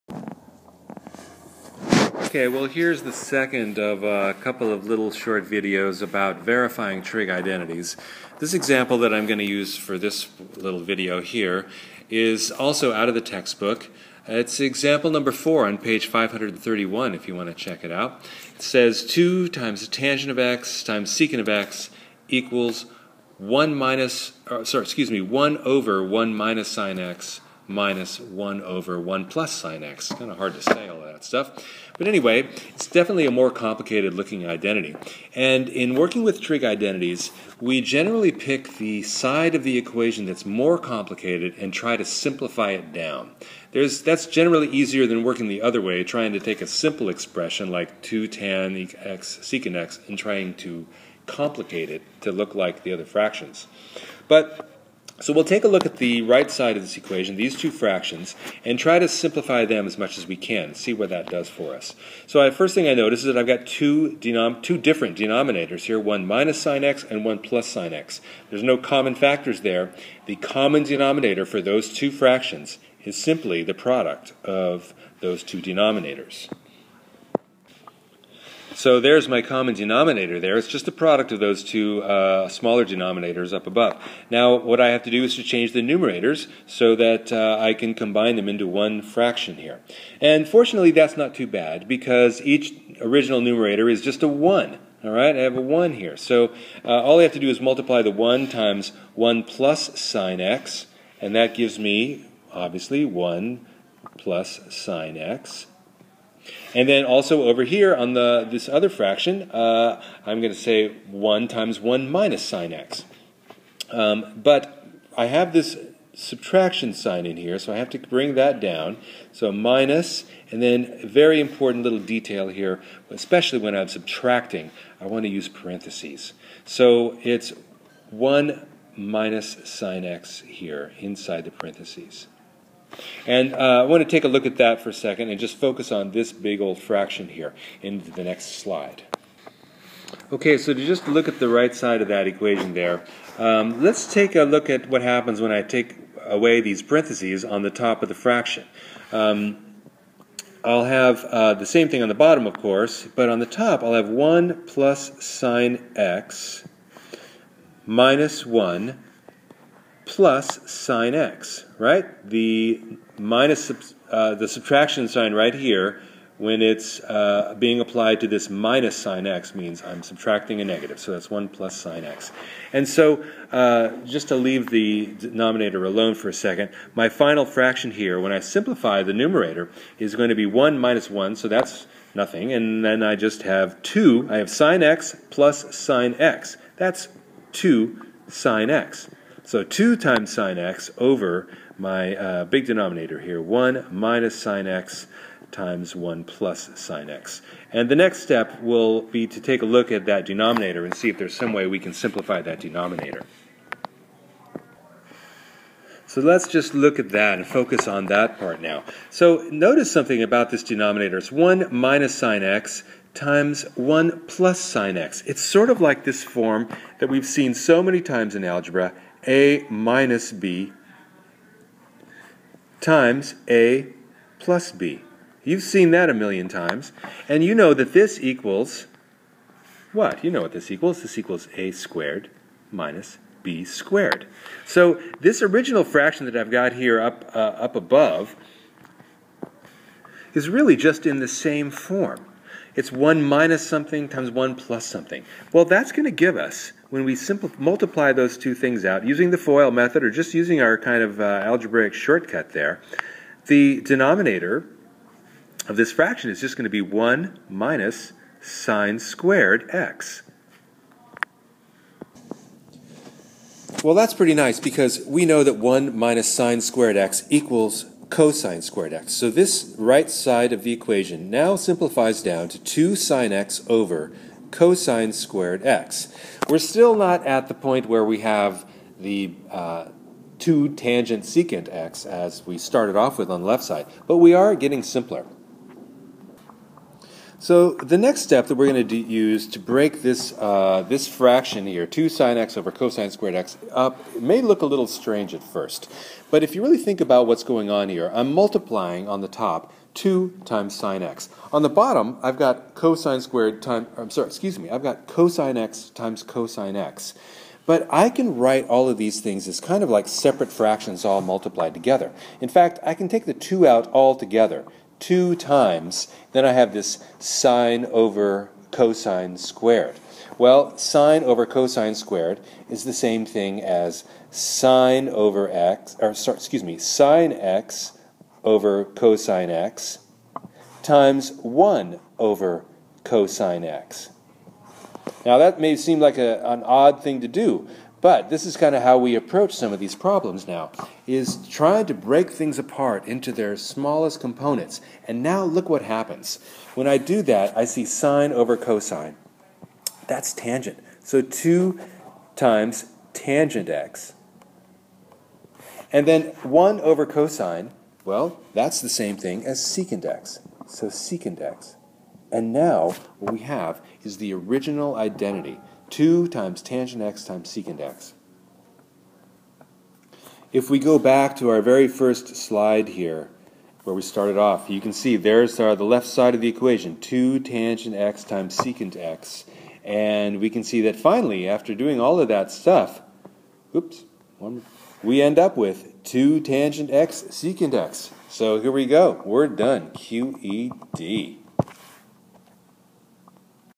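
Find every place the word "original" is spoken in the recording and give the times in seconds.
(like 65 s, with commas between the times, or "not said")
93 s, 235 s, 364 s.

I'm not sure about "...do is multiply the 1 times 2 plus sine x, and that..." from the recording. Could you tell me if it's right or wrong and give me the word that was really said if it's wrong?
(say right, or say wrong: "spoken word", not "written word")
wrong: "1", not "2".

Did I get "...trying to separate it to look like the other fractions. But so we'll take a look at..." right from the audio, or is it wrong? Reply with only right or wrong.
wrong.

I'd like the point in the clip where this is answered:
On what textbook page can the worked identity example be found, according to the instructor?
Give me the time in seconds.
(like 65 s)
15 s.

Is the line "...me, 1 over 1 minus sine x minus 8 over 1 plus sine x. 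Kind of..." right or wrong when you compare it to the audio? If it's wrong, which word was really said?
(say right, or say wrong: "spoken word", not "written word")
wrong: "1", not "8".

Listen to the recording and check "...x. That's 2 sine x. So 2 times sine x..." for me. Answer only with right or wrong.
right.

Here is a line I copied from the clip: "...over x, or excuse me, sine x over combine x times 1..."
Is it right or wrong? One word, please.
wrong.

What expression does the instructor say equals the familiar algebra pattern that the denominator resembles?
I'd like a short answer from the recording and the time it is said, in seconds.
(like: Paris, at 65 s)
a squared minus b squared, at 231 s.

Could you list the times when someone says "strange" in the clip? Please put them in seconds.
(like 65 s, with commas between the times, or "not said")
294 s.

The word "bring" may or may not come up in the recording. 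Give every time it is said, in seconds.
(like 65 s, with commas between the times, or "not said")
117 s.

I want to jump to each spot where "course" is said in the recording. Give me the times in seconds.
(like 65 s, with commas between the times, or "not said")
152 s.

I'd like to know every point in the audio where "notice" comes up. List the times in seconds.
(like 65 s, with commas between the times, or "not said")
62 s, 209 s.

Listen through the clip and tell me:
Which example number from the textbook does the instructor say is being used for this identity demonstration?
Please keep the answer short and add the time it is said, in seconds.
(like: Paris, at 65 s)
4, at 14 s.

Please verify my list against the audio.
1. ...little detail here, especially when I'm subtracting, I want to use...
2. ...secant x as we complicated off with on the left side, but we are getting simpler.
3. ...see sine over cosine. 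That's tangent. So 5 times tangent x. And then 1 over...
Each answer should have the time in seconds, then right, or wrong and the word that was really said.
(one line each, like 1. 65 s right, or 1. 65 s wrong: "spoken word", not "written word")
1. 121 s right
2. 281 s wrong: "started", not "complicated"
3. 347 s wrong: "2", not "5".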